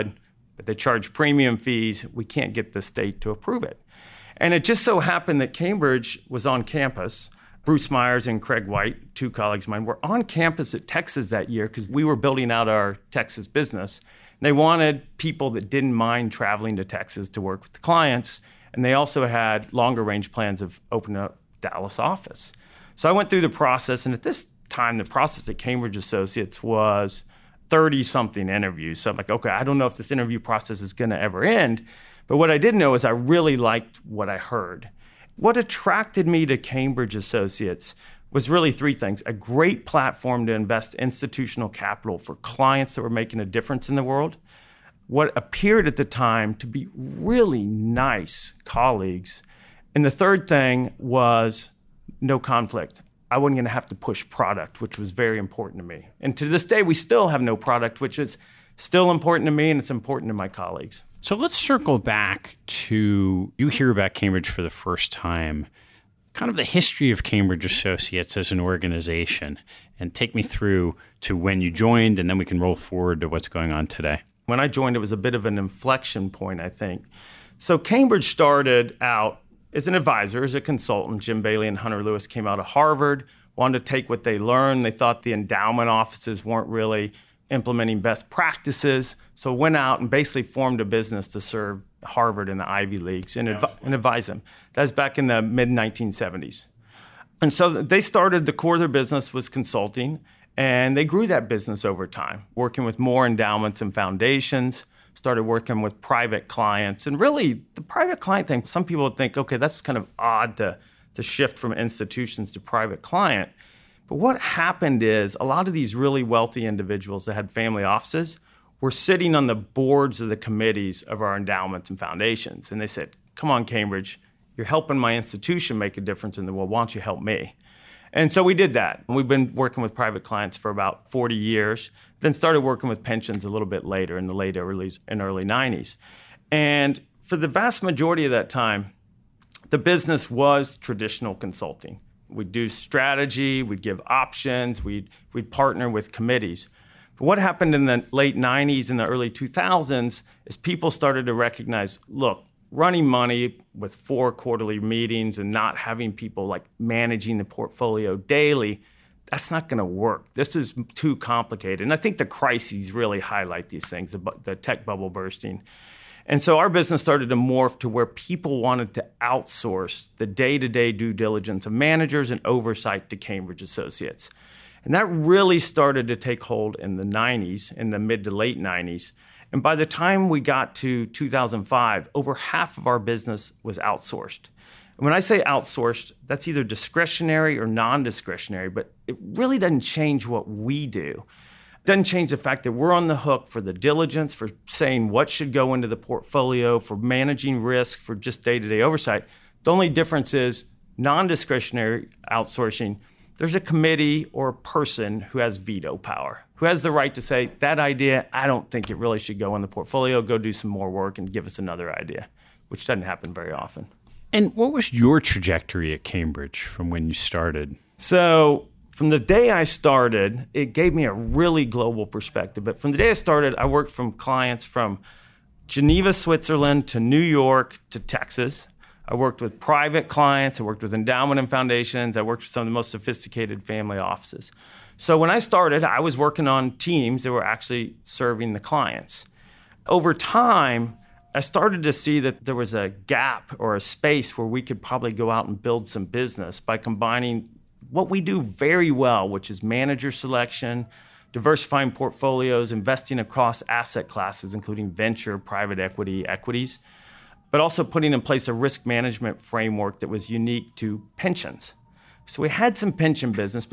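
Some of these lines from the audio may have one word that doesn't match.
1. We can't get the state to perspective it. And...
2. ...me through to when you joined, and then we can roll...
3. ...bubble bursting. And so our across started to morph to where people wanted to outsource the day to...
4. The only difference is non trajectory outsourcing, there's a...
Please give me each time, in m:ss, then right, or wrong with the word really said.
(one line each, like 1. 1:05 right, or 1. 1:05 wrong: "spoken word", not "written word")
1. 0:02 wrong: "approve", not "perspective"
2. 1:10 right
3. 2:44 wrong: "business", not "across"
4. 3:19 wrong: "discretionary", not "trajectory".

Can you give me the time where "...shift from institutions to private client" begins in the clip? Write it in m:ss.
1:51.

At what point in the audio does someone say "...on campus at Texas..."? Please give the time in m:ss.
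0:10.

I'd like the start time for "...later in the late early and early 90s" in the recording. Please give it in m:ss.
2:13.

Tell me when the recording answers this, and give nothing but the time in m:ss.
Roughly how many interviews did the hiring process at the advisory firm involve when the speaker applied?
0:27.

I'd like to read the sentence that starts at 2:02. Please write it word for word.
And they said, Come on, Cambridge, you're helping my institution make a difference in the world.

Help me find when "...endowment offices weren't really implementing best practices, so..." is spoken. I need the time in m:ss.
1:25.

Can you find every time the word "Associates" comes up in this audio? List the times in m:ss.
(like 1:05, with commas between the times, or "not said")
0:25, 0:37, 1:07, 2:53.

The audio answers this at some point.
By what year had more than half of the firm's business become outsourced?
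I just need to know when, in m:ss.
3:01.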